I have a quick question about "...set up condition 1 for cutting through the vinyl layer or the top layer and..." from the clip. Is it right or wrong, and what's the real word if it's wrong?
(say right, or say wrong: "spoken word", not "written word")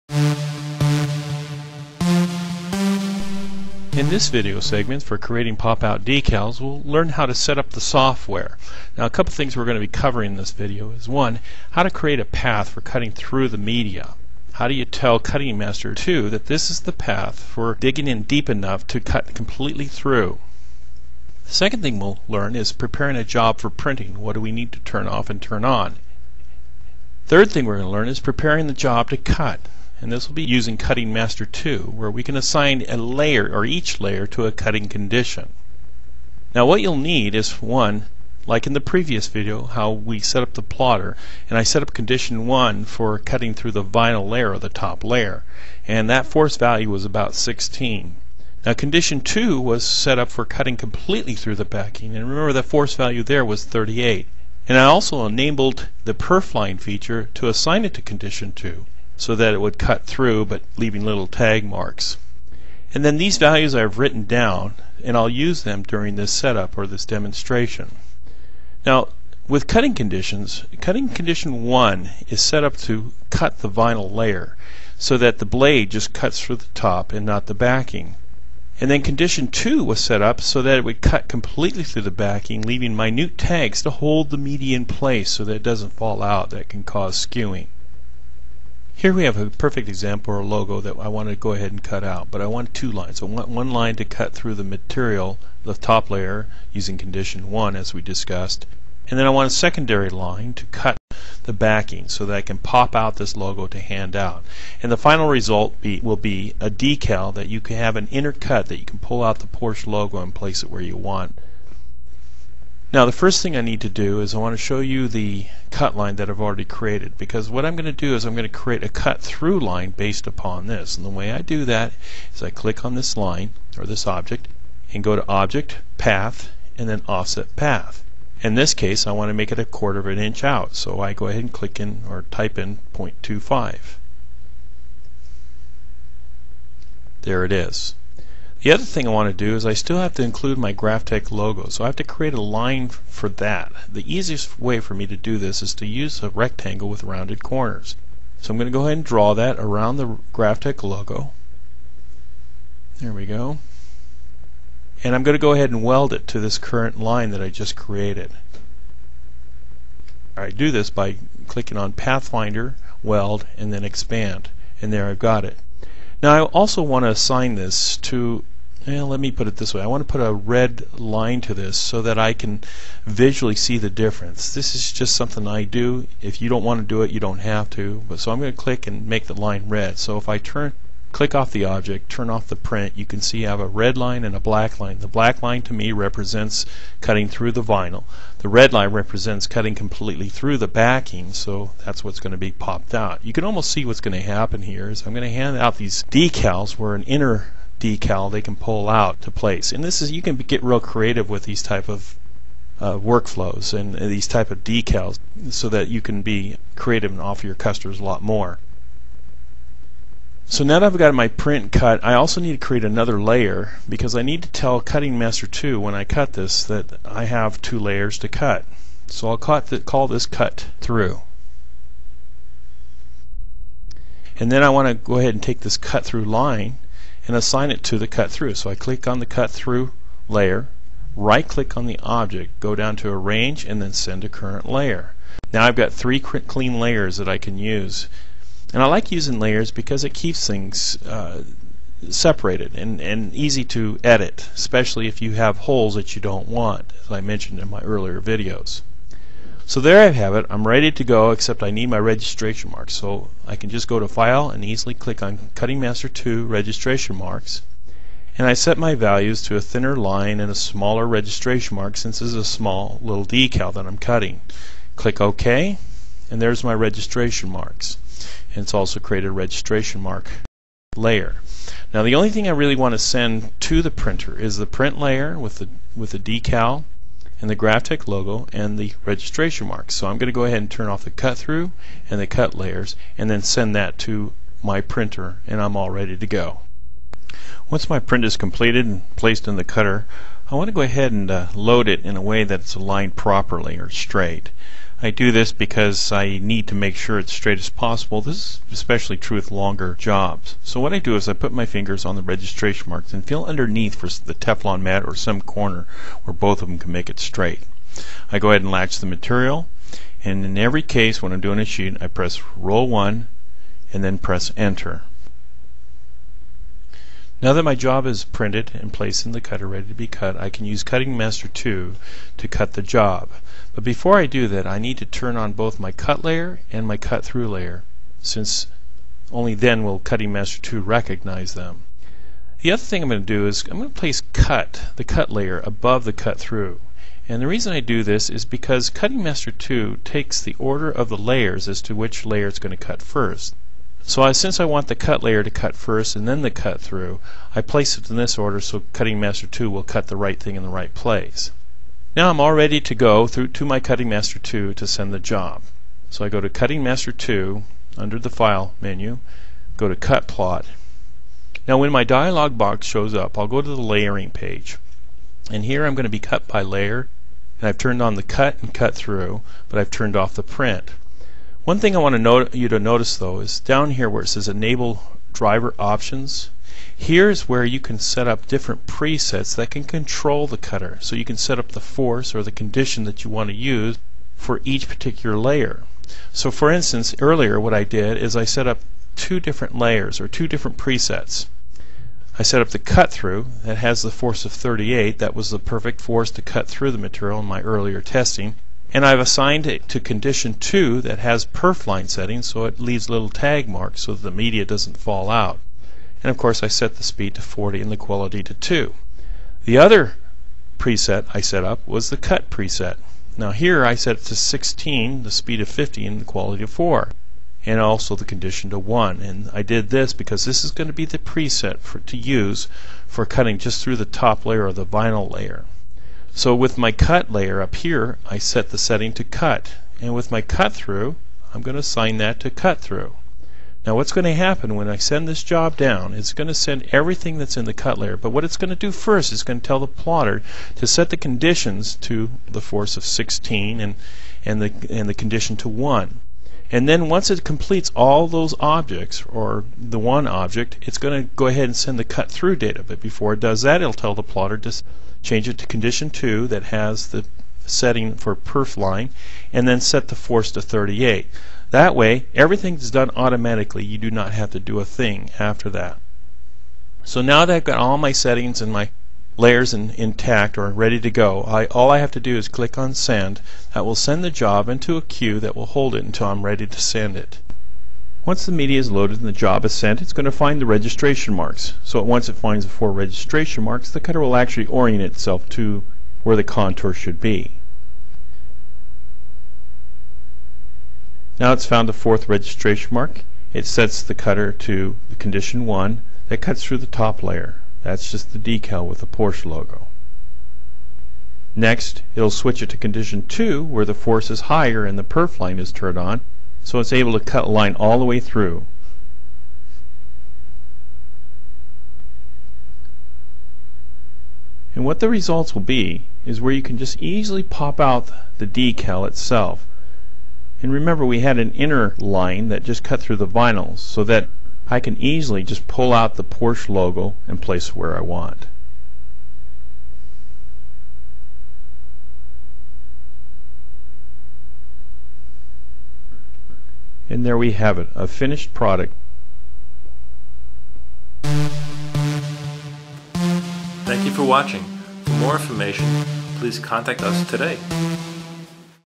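right.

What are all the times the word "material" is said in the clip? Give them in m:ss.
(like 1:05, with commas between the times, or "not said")
1:34, 5:09, 6:36.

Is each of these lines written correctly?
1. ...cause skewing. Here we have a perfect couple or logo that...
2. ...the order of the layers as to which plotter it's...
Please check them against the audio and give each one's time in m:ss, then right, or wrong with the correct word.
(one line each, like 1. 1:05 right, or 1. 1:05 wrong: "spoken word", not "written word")
1. 1:26 wrong: "example", not "couple"
2. 5:40 wrong: "layer", not "plotter".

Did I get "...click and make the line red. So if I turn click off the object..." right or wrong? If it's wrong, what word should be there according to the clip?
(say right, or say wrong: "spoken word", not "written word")
right.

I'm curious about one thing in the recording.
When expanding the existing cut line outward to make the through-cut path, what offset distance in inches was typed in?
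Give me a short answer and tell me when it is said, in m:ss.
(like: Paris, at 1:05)
0.25, at 2:12.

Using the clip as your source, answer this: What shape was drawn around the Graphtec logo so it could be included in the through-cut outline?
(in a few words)
rectangle with rounded corners.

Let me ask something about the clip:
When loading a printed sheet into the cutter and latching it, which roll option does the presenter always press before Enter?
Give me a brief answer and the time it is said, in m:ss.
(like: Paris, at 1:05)
roll 1, at 5:12.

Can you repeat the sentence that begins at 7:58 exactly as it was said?
Once the media is loaded and the job is sent, it's going to find the registration marks.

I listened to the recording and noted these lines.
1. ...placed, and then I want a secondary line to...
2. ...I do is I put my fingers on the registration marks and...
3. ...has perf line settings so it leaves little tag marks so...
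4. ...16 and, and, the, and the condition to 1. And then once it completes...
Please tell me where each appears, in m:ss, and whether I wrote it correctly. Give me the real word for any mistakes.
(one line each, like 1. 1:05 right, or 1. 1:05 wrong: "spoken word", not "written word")
1. 1:38 wrong: "discussed", not "placed"
2. 5:00 right
3. 6:41 right
4. 7:23 right.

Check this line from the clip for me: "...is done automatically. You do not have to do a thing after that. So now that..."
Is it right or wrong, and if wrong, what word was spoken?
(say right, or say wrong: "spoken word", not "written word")
right.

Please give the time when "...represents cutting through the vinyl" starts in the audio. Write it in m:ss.
3:05.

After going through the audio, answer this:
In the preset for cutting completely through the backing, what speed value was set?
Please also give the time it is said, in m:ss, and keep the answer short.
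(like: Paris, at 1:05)
40, at 6:47.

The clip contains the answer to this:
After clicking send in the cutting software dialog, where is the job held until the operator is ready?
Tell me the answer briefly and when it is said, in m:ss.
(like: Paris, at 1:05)
a queue, at 7:55.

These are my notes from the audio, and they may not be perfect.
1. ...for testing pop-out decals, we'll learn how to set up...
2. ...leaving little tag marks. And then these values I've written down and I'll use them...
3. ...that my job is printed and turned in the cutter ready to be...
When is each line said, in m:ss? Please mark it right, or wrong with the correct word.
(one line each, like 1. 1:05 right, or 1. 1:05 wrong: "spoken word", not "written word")
1. 0:05 wrong: "creating", not "testing"
2. 1:00 right
3. 5:17 wrong: "placed", not "turned".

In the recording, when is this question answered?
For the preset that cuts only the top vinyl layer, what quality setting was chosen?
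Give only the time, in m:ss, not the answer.
6:56.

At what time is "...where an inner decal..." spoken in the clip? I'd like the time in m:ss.
3:16.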